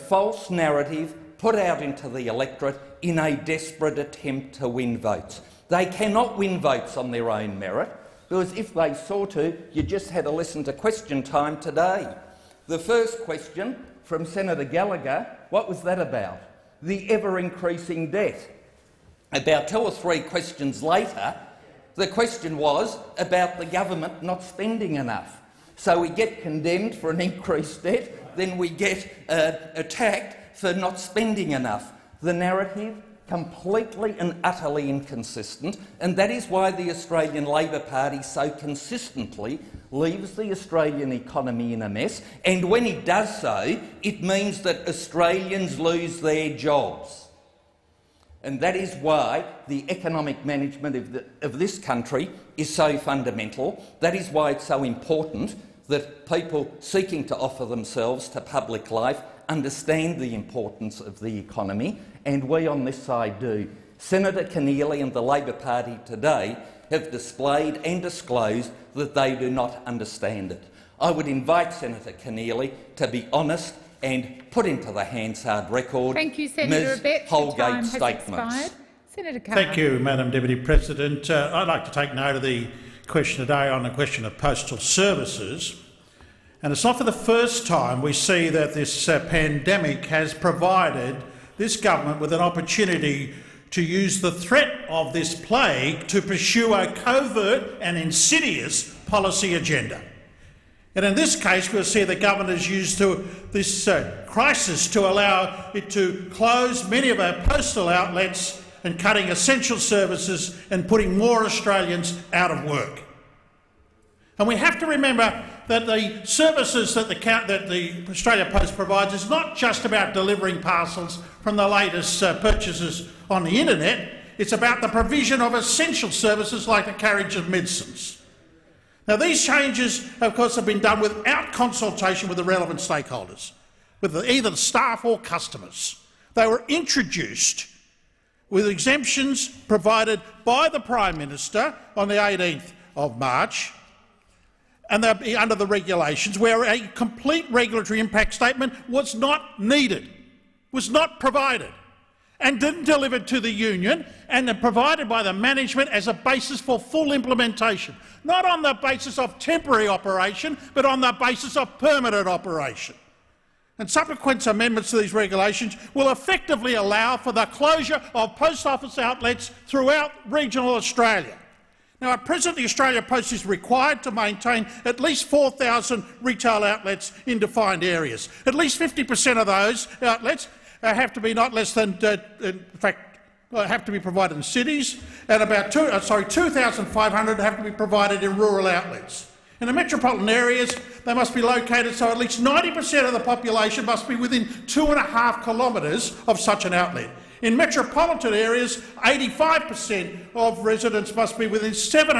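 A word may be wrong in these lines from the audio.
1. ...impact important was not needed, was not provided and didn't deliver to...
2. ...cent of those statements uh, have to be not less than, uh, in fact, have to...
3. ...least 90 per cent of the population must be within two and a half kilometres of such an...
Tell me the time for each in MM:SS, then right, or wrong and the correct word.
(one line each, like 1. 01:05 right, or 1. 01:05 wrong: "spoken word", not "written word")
1. 02:27 wrong: "statement", not "important"
2. 02:59 wrong: "outlets", not "statements"
3. 03:12 right.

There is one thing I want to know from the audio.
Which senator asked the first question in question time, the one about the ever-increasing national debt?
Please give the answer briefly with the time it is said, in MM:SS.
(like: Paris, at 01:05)
Senator Gallagher, at 00:14.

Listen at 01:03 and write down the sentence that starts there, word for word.
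Senator Keneally and the Labor Party today have displayed and disclosed that they do not understand it.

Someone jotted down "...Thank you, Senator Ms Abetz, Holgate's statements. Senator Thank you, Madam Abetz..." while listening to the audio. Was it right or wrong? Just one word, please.
wrong.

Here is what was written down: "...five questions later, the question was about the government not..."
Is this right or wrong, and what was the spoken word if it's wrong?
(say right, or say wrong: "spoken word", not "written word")
wrong: "three", not "five".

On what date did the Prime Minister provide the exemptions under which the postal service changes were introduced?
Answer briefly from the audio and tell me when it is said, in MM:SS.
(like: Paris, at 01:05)
18th of March, at 02:22.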